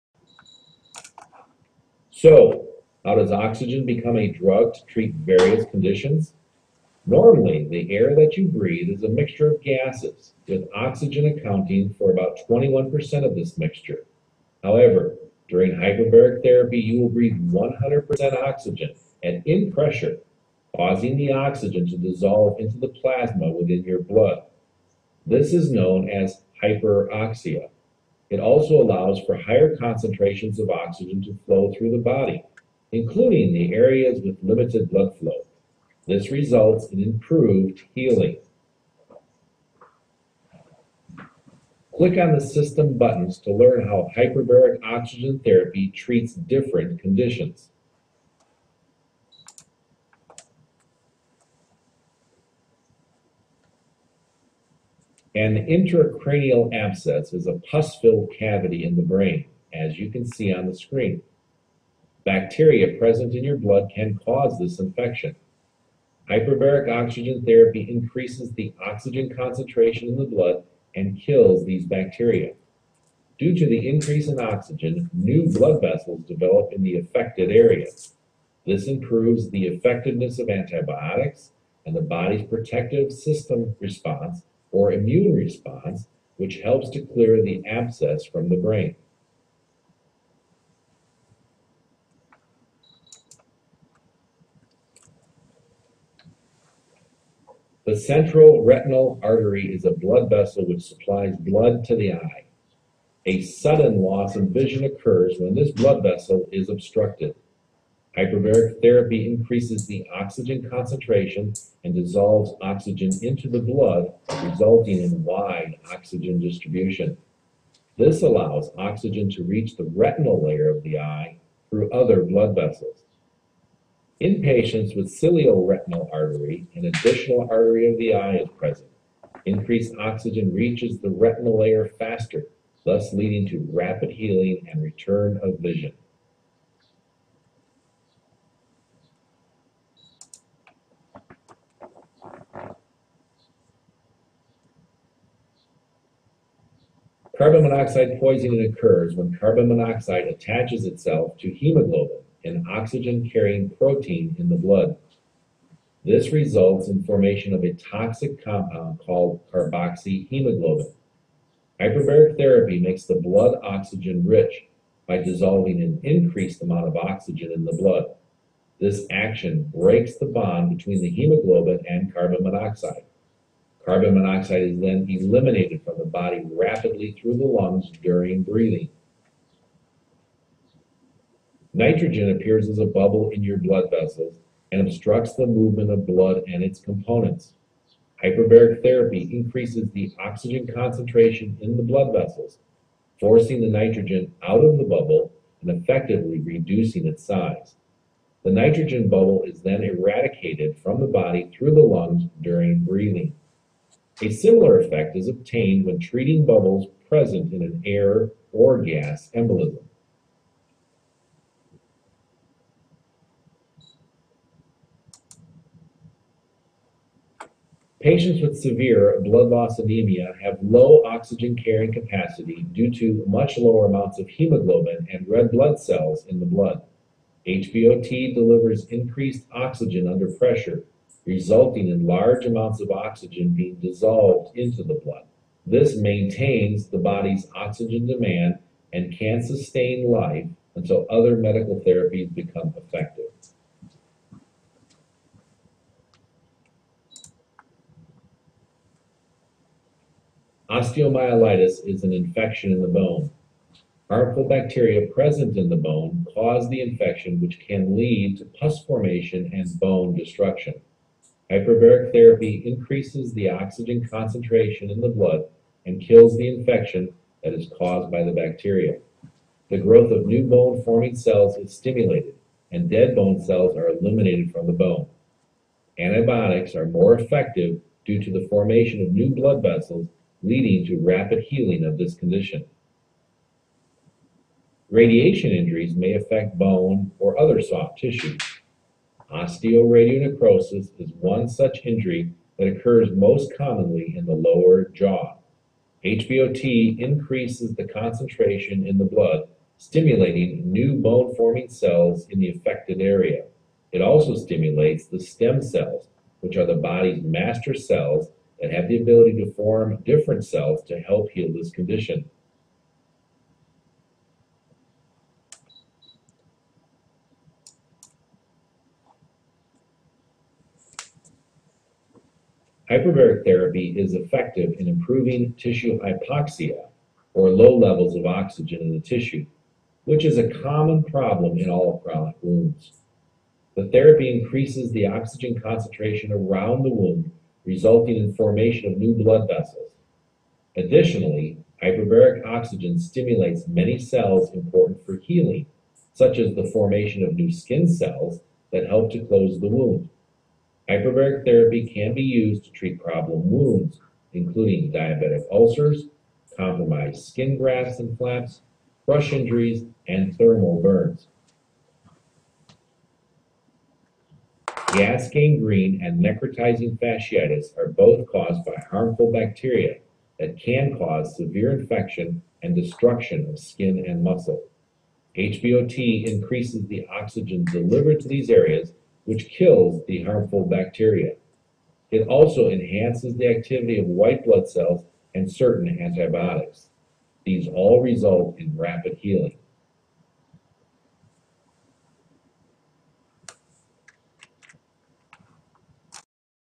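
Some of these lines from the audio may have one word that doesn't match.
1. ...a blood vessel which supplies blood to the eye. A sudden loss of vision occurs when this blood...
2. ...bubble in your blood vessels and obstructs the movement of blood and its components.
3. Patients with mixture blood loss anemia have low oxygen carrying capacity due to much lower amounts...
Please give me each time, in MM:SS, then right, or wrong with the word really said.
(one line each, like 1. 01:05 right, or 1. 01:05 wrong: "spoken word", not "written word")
1. 01:39 right
2. 03:02 right
3. 03:37 wrong: "severe", not "mixture".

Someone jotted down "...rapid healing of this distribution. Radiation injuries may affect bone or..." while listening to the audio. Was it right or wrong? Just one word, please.
wrong.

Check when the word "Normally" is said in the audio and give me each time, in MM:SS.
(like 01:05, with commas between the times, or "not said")
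00:07.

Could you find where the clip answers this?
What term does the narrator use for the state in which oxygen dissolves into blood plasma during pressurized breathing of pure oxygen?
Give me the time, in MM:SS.
00:26.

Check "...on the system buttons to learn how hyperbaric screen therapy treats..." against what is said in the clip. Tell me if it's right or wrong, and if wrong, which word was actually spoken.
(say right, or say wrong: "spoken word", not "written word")
wrong: "oxygen", not "screen".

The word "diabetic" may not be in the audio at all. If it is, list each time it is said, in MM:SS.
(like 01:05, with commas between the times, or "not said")
05:54.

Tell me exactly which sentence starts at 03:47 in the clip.
HBOT delivers increased oxygen under pressure, resulting in large amounts of oxygen being dissolved into the blood.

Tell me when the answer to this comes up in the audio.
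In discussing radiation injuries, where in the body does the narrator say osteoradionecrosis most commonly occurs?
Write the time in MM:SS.
04:54.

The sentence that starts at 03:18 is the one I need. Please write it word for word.
The nitrogen bubble is then eradicated from the body through the lungs during breathing.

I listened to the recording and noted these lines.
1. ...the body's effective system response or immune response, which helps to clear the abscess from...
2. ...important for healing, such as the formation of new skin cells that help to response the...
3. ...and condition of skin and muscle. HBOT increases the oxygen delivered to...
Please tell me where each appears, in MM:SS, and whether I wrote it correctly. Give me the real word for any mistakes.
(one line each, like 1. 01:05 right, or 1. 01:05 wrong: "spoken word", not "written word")
1. 01:21 wrong: "protective", not "effective"
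2. 05:44 wrong: "close", not "response"
3. 06:12 wrong: "destruction", not "condition".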